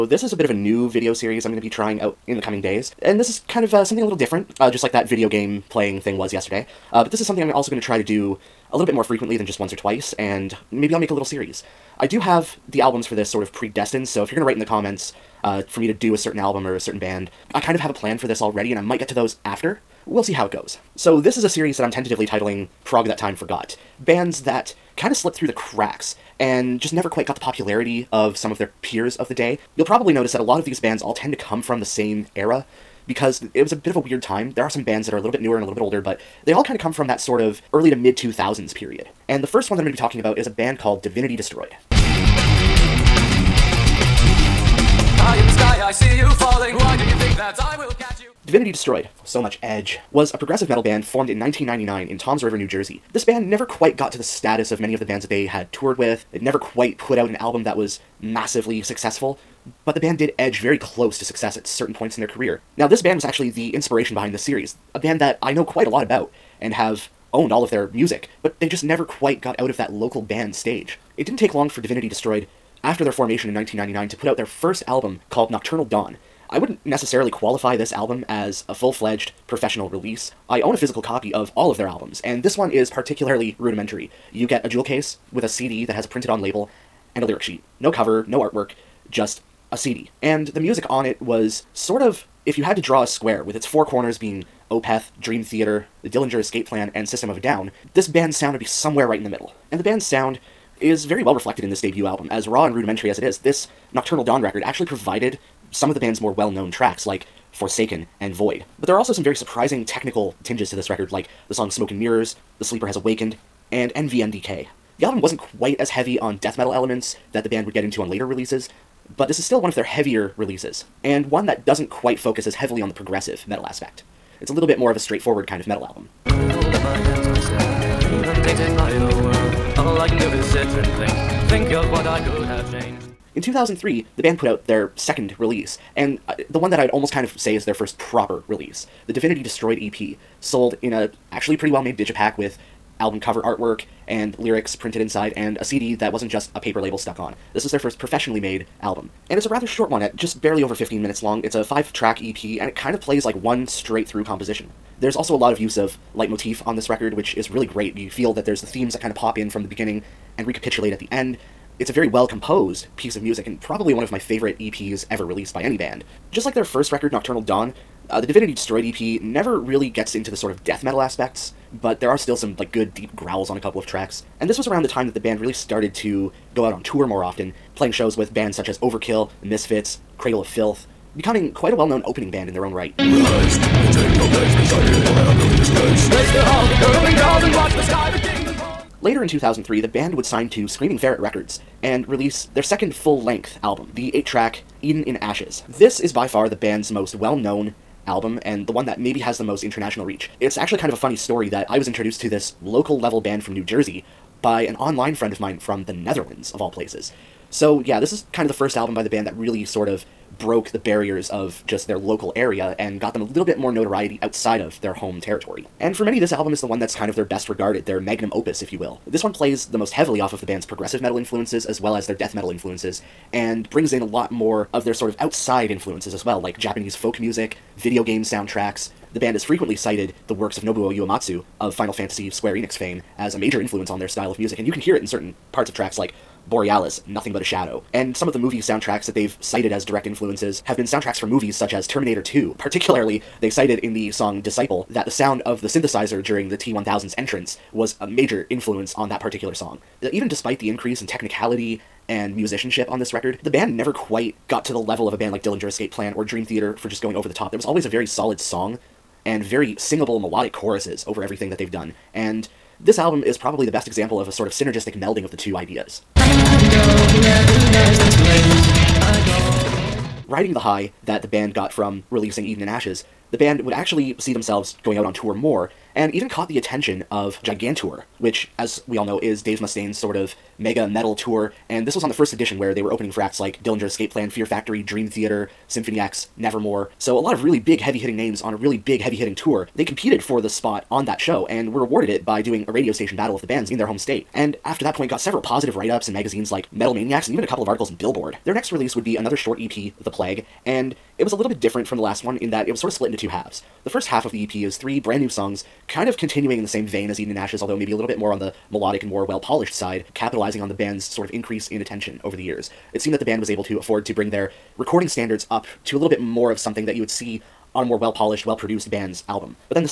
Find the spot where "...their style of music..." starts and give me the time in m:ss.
3:54.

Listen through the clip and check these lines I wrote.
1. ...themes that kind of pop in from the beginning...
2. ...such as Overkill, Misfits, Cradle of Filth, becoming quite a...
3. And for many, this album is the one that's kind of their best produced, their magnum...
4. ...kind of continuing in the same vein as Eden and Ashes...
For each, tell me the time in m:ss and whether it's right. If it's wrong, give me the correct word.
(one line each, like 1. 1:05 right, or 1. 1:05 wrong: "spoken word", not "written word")
1. 2:38 right
2. 2:58 right
3. 3:35 wrong: "regarded", not "produced"
4. 5:05 right.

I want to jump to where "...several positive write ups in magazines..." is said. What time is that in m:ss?
4:55.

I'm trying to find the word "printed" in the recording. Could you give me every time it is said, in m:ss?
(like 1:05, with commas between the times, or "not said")
1:26, 2:24.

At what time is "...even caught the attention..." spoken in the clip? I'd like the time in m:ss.
4:36.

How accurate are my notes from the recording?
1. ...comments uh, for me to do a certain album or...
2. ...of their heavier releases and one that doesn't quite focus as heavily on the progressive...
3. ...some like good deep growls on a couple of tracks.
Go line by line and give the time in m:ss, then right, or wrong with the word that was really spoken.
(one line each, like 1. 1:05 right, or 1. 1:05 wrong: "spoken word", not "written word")
1. 0:14 right
2. 1:59 right
3. 2:52 right.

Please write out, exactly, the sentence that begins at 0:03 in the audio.
And this is kind of uh, something a little different, uh, just like that video game playing thing was yesterday.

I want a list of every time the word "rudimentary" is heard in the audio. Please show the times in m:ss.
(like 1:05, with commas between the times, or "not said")
1:23, 1:42.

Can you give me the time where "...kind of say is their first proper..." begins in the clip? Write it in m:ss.
2:17.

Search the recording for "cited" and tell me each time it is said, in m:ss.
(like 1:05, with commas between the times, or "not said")
3:49, 3:59, 4:03.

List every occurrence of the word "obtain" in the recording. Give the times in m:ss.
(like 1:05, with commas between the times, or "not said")
not said.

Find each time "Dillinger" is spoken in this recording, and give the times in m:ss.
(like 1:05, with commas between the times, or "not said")
1:36, 4:15, 4:43.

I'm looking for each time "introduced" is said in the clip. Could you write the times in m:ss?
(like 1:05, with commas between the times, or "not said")
3:21.